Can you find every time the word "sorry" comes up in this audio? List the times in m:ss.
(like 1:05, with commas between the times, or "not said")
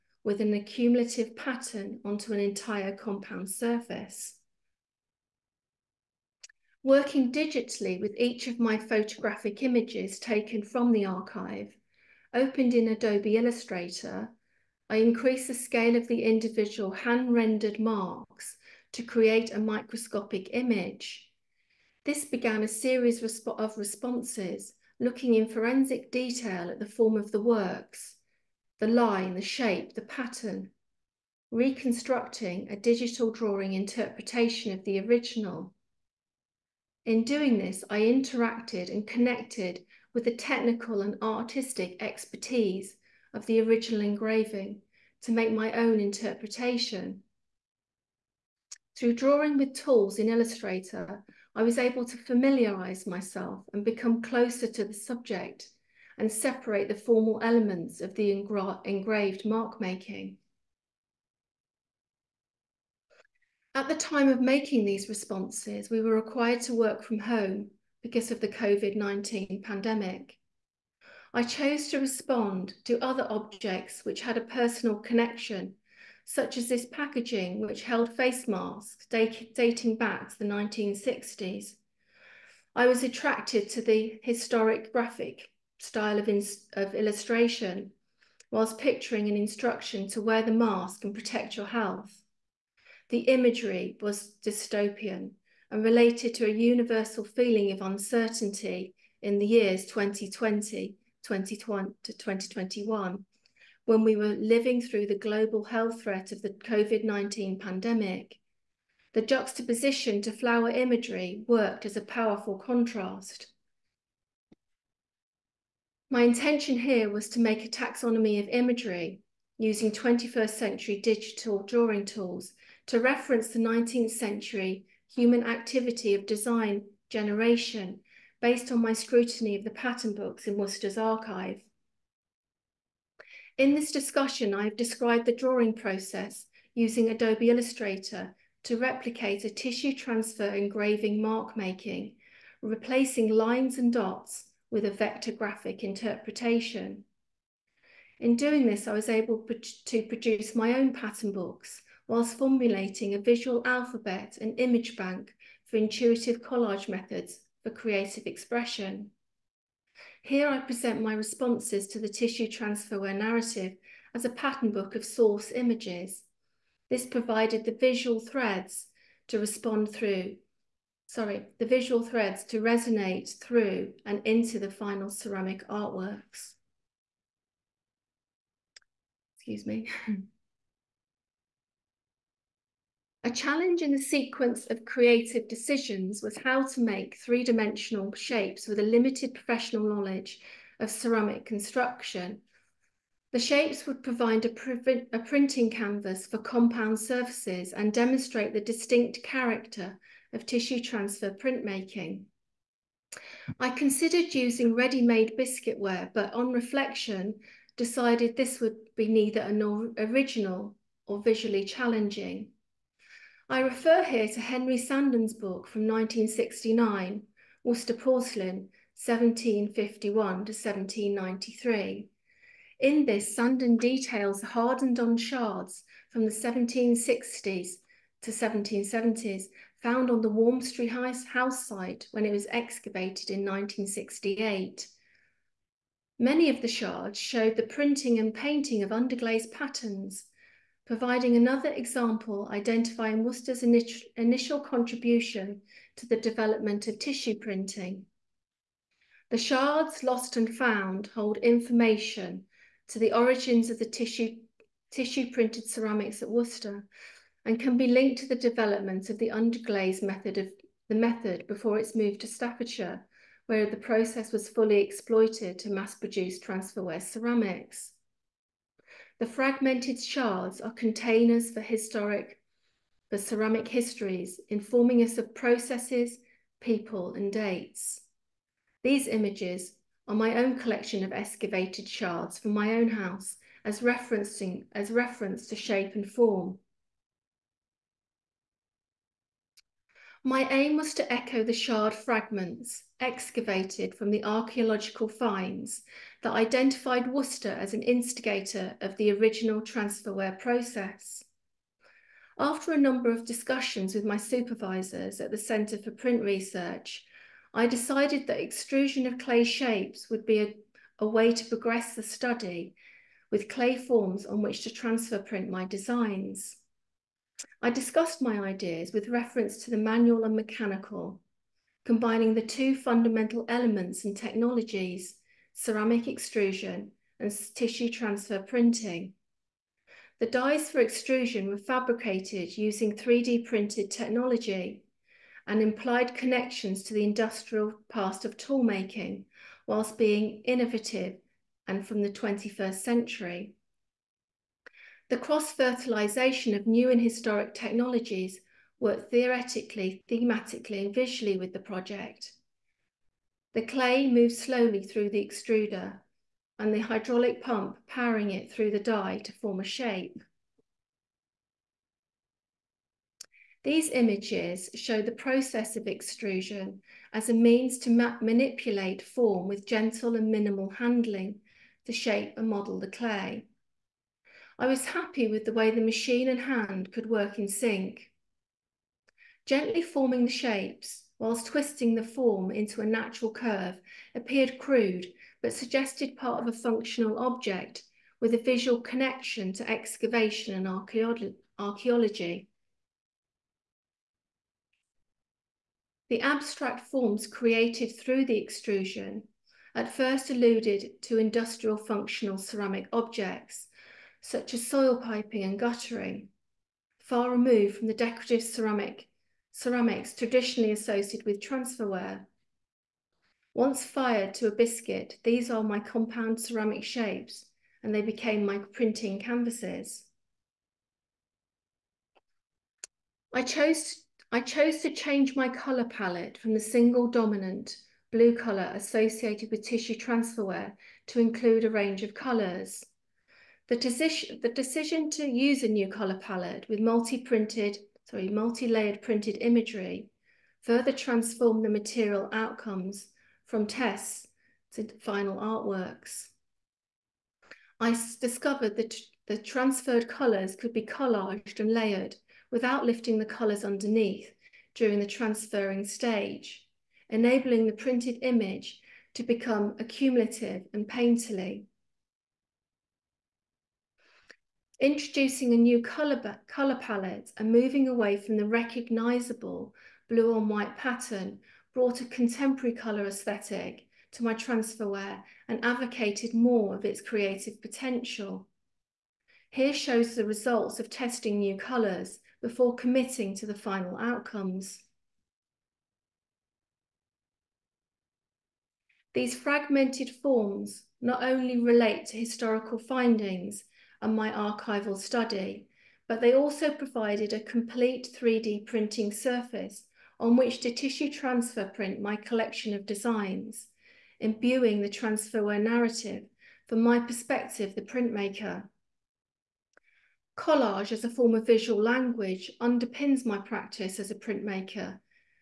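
2:51, 7:18.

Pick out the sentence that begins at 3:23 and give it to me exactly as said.
I considered using ready-made biscuitware, but on reflection, decided this would be neither an original or visually challenging.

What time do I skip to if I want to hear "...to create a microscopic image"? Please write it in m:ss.
0:18.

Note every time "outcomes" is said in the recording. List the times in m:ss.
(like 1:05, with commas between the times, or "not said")
7:22, 8:03.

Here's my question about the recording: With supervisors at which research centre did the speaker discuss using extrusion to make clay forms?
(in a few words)
Centre for Print Research.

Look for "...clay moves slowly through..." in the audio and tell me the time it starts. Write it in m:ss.
5:53.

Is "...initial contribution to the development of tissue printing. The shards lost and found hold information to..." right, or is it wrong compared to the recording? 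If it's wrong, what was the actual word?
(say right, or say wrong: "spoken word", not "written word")
right.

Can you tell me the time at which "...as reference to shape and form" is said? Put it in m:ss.
4:44.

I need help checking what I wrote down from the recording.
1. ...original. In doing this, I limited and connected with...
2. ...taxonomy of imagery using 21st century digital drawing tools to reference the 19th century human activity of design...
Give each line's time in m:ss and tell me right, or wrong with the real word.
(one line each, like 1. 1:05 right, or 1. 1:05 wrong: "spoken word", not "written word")
1. 0:34 wrong: "interacted", not "limited"
2. 1:57 right.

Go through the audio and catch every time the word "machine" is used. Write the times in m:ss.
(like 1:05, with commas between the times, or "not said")
6:15.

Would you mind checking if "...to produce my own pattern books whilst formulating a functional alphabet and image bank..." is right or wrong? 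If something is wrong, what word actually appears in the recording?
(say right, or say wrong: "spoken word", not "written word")
wrong: "visual", not "functional".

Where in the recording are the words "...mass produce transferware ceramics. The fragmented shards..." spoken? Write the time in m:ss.
4:25.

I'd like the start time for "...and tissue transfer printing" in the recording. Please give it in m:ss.
5:27.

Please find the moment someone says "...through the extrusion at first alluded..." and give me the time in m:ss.
6:37.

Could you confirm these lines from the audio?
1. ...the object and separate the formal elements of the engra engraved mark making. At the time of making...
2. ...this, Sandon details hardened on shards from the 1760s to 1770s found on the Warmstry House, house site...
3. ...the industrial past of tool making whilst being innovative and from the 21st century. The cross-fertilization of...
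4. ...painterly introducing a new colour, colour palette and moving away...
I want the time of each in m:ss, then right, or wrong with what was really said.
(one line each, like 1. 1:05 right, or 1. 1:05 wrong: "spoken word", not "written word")
1. 0:54 wrong: "subject", not "object"
2. 3:43 right
3. 5:36 right
4. 7:40 right.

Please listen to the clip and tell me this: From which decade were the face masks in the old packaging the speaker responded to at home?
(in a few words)
1960s.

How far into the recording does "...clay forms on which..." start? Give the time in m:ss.
5:13.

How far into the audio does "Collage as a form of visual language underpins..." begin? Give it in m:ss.
8:30.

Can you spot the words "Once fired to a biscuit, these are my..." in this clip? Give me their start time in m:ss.
6:53.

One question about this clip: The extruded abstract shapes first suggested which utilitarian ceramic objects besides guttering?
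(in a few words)
soil piping.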